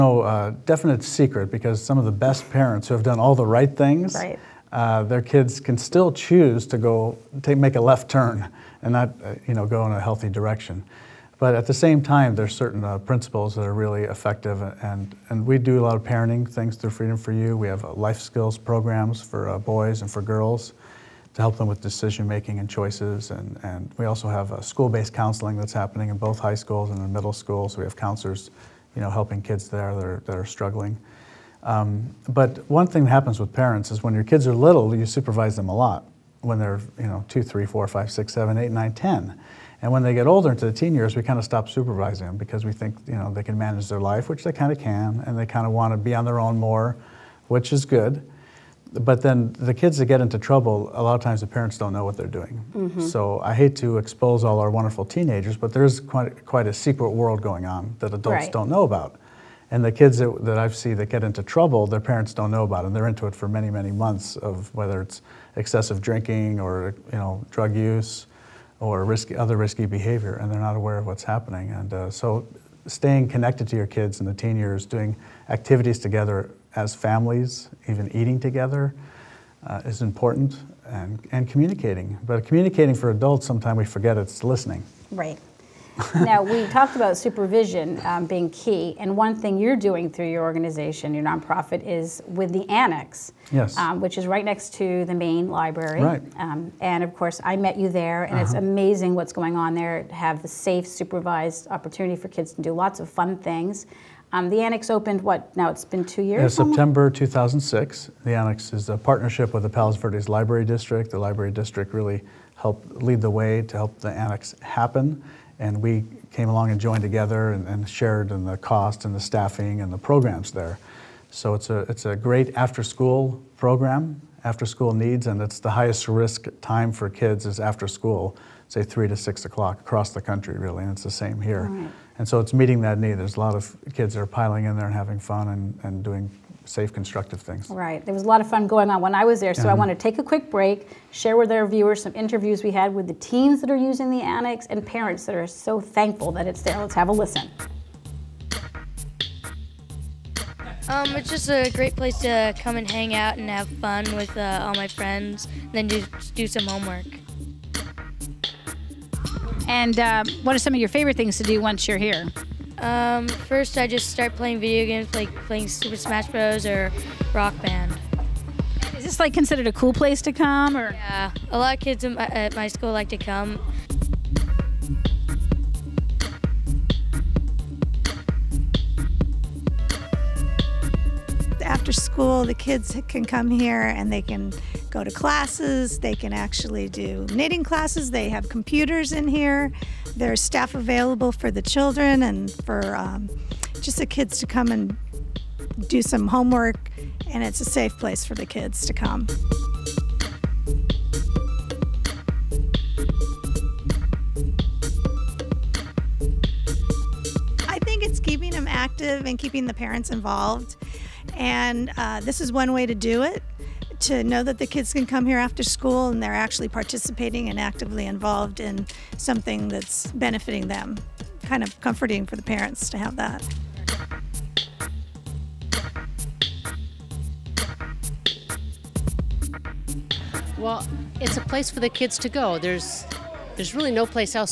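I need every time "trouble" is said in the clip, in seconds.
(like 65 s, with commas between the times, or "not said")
50 s, 61 s.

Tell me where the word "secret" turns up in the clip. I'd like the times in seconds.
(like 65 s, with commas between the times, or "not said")
1 s, 56 s.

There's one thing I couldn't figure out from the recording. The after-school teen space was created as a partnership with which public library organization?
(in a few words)
Palos Verdes Library District.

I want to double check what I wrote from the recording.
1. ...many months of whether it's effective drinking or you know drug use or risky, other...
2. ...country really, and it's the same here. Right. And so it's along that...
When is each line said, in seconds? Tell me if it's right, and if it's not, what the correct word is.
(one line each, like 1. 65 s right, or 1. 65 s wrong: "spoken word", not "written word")
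1. 63 s wrong: "excessive", not "effective"
2. 130 s wrong: "meeting", not "along".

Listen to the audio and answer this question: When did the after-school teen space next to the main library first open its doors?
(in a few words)
September 2006.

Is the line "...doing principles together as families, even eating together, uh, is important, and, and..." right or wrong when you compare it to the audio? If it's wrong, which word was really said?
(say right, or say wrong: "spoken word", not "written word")
wrong: "activities", not "principles".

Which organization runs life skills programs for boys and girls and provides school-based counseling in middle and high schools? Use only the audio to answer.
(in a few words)
Freedom for You.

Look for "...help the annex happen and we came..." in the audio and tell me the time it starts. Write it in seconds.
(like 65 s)
113 s.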